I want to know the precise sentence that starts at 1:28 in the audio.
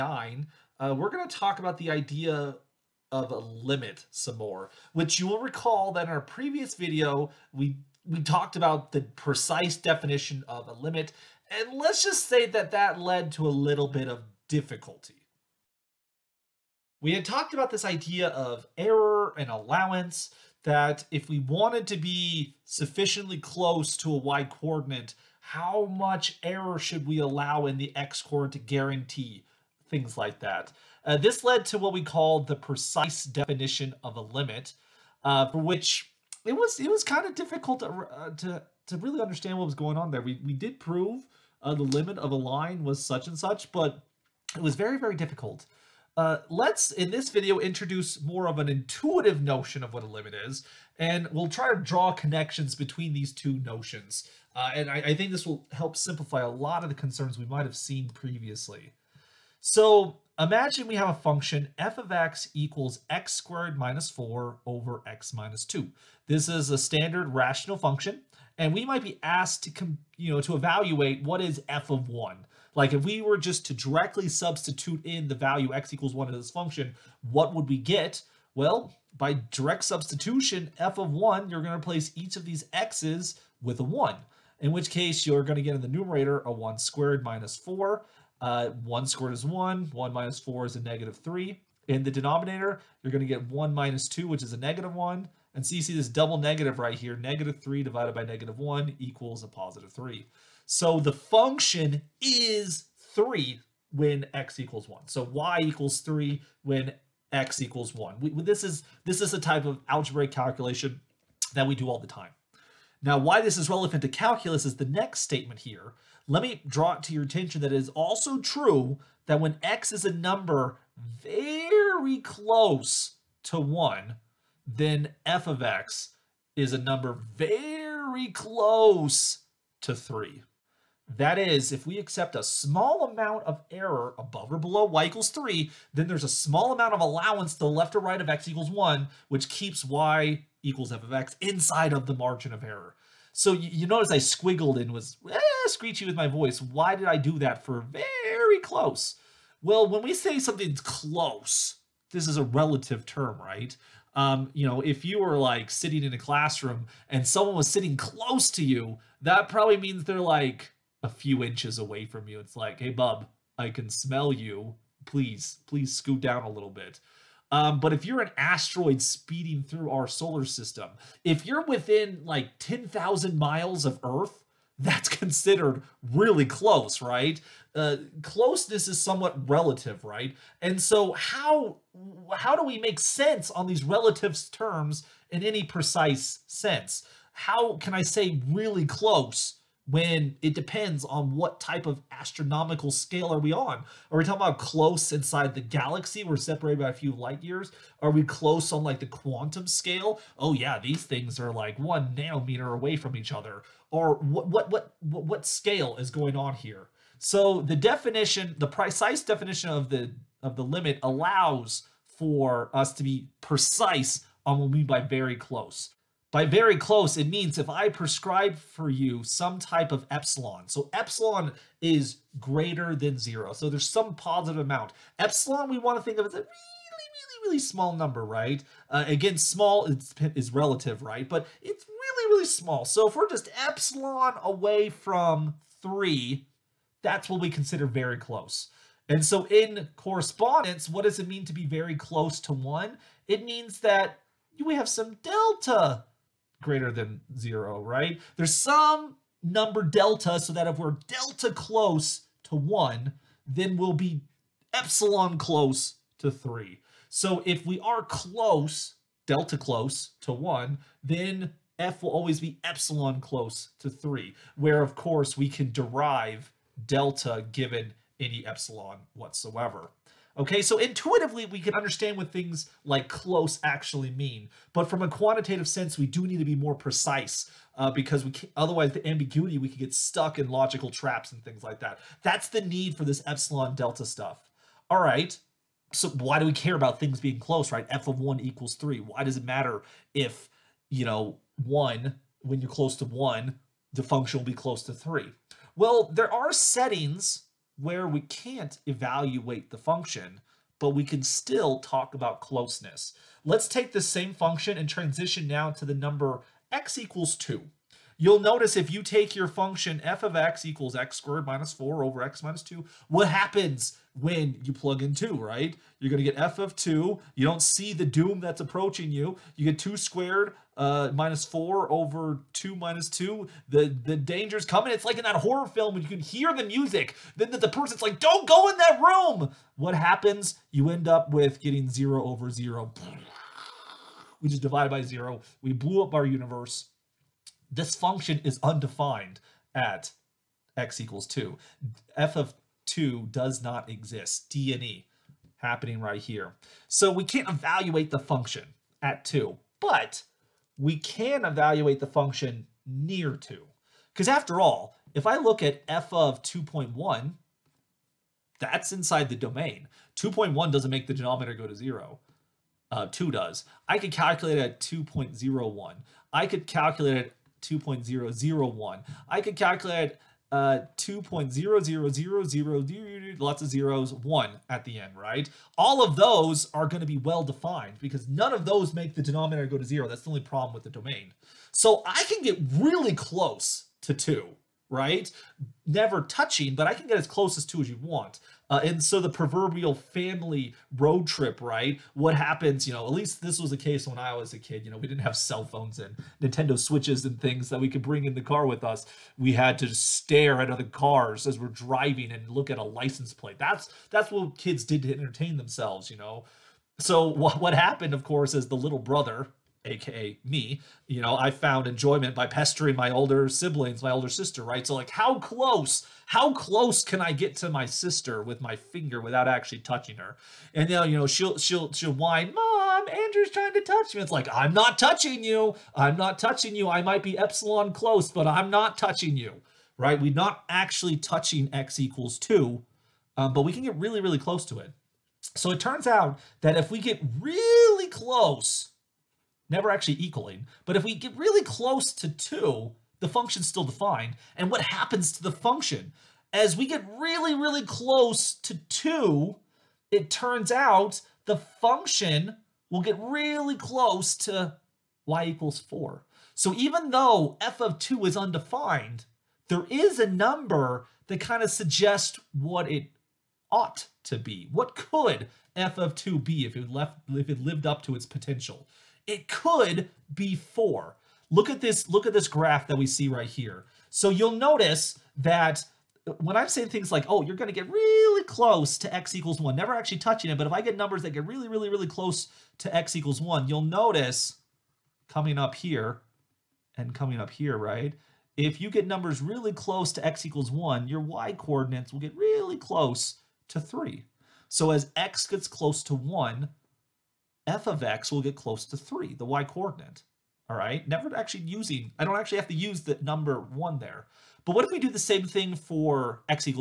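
Uh, 1 squared is 1, 1 minus 4 is a negative 3.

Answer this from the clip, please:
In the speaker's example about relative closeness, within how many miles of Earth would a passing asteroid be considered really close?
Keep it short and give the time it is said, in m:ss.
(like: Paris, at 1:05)
10,000 miles, at 2:52.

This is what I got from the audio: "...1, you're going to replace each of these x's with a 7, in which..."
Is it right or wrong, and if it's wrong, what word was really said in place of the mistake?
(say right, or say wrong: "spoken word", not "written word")
wrong: "1", not "7".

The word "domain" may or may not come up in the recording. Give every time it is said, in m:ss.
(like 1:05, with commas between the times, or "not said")
5:59, 6:20.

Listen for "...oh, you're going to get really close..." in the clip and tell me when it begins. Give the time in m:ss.
7:57.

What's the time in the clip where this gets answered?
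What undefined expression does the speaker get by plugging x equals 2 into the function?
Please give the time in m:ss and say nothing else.
5:31.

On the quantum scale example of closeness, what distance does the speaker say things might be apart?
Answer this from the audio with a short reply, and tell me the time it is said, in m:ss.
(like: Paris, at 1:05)
one nanometer, at 3:21.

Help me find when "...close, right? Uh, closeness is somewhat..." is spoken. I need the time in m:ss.
2:56.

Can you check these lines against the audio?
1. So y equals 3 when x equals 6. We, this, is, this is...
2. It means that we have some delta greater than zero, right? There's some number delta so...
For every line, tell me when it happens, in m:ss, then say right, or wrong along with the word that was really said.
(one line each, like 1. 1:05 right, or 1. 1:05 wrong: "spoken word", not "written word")
1. 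1:45 wrong: "1", not "6"
2. 4:03 right.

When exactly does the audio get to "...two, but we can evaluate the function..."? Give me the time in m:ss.
5:49.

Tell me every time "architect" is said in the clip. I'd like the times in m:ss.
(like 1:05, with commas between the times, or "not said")
not said.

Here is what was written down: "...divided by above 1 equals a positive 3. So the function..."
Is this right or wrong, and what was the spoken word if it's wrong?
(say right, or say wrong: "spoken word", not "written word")
wrong: "negative", not "above".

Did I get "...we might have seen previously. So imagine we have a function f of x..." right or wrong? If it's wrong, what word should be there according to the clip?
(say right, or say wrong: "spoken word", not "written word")
right.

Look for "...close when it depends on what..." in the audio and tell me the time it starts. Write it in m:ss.
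3:08.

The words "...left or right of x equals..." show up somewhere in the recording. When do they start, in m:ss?
2:17.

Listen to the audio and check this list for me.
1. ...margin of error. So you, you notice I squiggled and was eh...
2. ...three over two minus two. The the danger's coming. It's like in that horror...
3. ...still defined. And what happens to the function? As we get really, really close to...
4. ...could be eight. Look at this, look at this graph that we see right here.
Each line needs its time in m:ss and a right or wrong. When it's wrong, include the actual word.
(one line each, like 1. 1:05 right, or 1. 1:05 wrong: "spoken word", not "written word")
1. 2:22 right
2. 5:21 wrong: "four", not "three"
3. 7:23 right
4. 7:49 wrong: "four", not "eight".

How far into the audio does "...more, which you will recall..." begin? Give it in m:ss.
0:04.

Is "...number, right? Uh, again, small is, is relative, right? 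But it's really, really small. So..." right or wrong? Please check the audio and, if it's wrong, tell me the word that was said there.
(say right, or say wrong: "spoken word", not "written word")
right.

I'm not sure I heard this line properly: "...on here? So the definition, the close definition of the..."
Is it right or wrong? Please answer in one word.
wrong.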